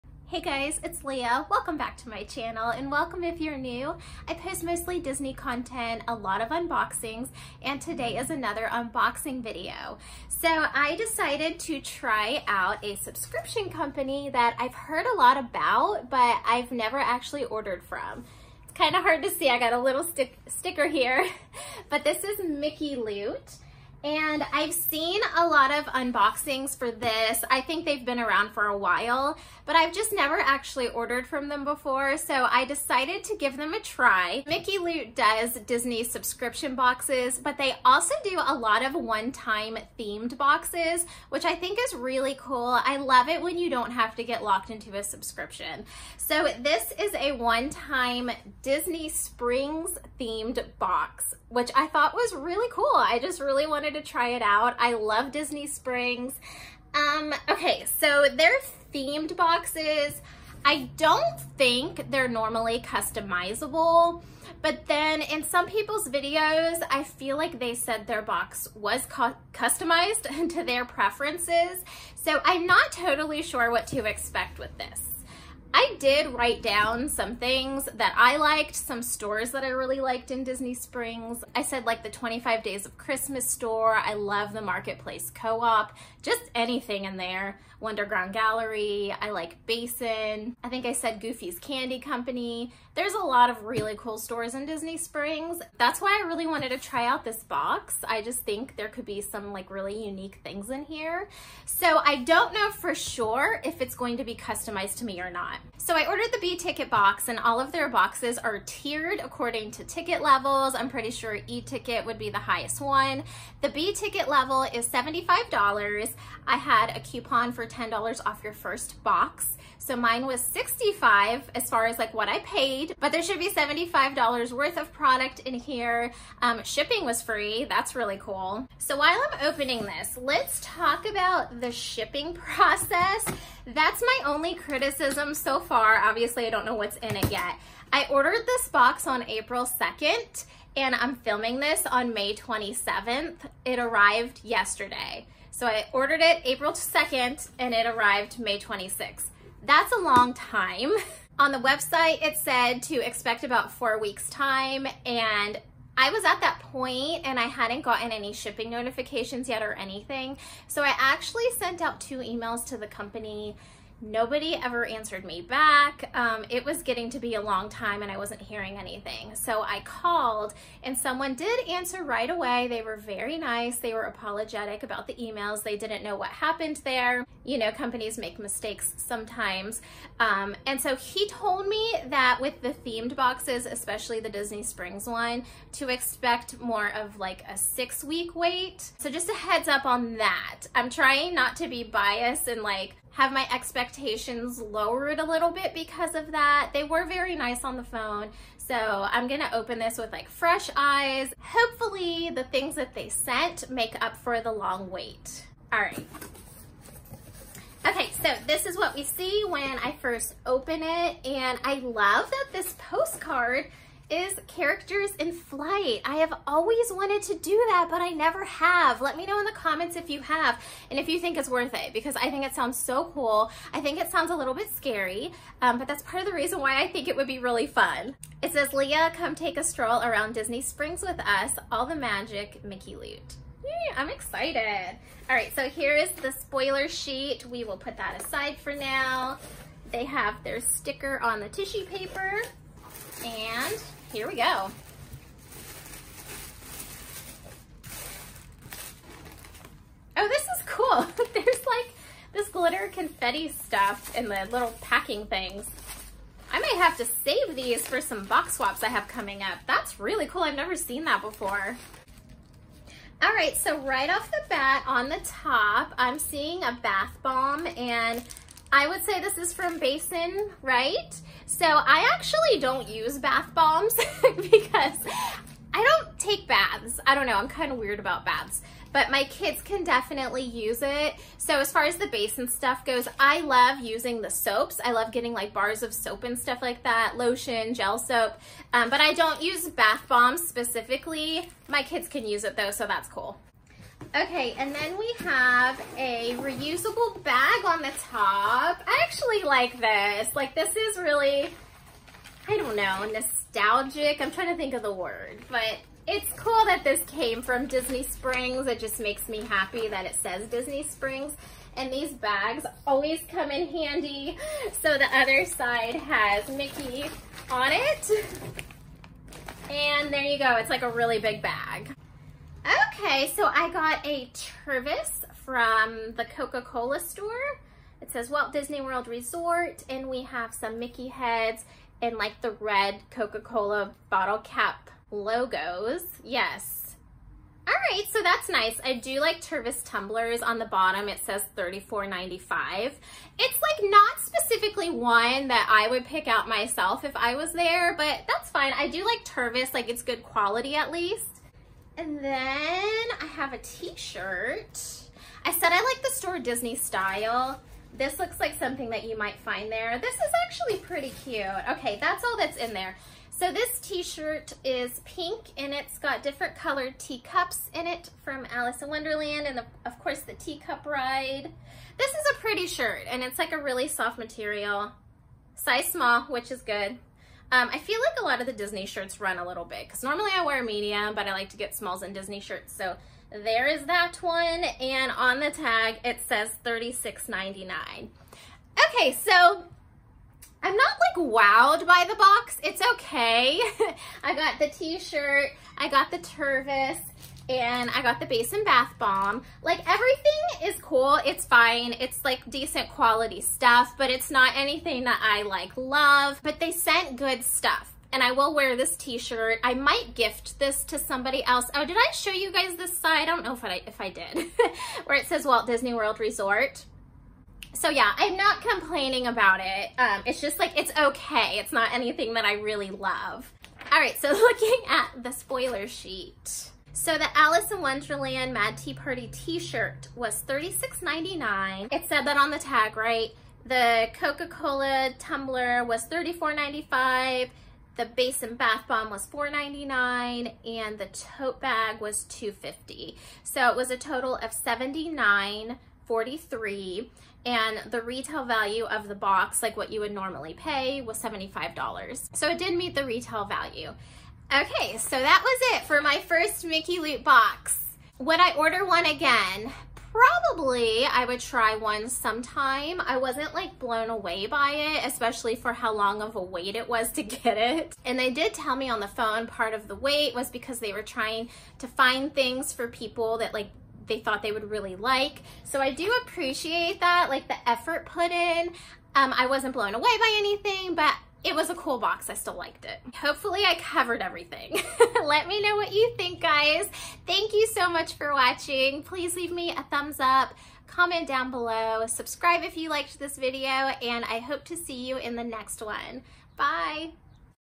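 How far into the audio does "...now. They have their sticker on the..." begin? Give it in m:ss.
3:58.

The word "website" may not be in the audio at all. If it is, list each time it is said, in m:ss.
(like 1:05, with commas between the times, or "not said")
2:31.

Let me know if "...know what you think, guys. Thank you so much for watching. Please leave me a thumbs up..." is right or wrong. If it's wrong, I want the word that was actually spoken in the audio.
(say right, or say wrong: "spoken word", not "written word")
right.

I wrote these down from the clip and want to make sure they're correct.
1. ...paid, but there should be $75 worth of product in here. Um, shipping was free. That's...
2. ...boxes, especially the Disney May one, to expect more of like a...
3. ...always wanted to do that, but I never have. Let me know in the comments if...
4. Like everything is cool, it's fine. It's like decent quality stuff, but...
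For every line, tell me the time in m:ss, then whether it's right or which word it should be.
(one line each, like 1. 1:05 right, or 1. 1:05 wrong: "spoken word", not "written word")
1. 2:02 right
2. 3:03 wrong: "Springs", not "May"
3. 3:36 right
4. 6:39 right.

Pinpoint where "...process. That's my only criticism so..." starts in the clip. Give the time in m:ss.
2:12.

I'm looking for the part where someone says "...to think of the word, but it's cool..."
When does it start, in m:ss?
5:04.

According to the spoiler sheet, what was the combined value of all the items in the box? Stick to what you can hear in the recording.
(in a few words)
$79.43.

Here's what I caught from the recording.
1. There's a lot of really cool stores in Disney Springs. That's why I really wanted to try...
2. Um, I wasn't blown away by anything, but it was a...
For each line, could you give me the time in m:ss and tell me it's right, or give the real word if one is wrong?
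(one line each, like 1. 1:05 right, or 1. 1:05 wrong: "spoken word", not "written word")
1. 1:32 right
2. 7:59 right.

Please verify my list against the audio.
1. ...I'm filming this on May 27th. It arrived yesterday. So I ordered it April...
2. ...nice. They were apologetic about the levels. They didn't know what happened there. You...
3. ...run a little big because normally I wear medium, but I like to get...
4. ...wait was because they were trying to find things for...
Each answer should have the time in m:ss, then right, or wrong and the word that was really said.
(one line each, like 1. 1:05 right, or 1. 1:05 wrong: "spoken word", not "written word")
1. 2:20 right
2. 2:53 wrong: "emails", not "levels"
3. 6:19 right
4. 7:49 right.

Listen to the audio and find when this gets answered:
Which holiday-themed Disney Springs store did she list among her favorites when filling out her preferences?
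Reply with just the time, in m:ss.
1:22.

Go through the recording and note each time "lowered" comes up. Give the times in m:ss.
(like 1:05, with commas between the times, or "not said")
3:14.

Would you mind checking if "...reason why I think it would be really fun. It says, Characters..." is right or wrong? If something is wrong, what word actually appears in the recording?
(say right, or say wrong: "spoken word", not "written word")
wrong: "Lia", not "Characters".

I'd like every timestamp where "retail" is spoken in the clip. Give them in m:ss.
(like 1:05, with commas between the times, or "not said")
7:28, 7:33.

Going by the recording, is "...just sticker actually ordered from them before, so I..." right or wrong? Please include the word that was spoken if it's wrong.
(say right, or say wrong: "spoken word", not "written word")
wrong: "never", not "sticker".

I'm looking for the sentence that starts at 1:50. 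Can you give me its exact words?
I'm pretty sure E ticket would be the highest one.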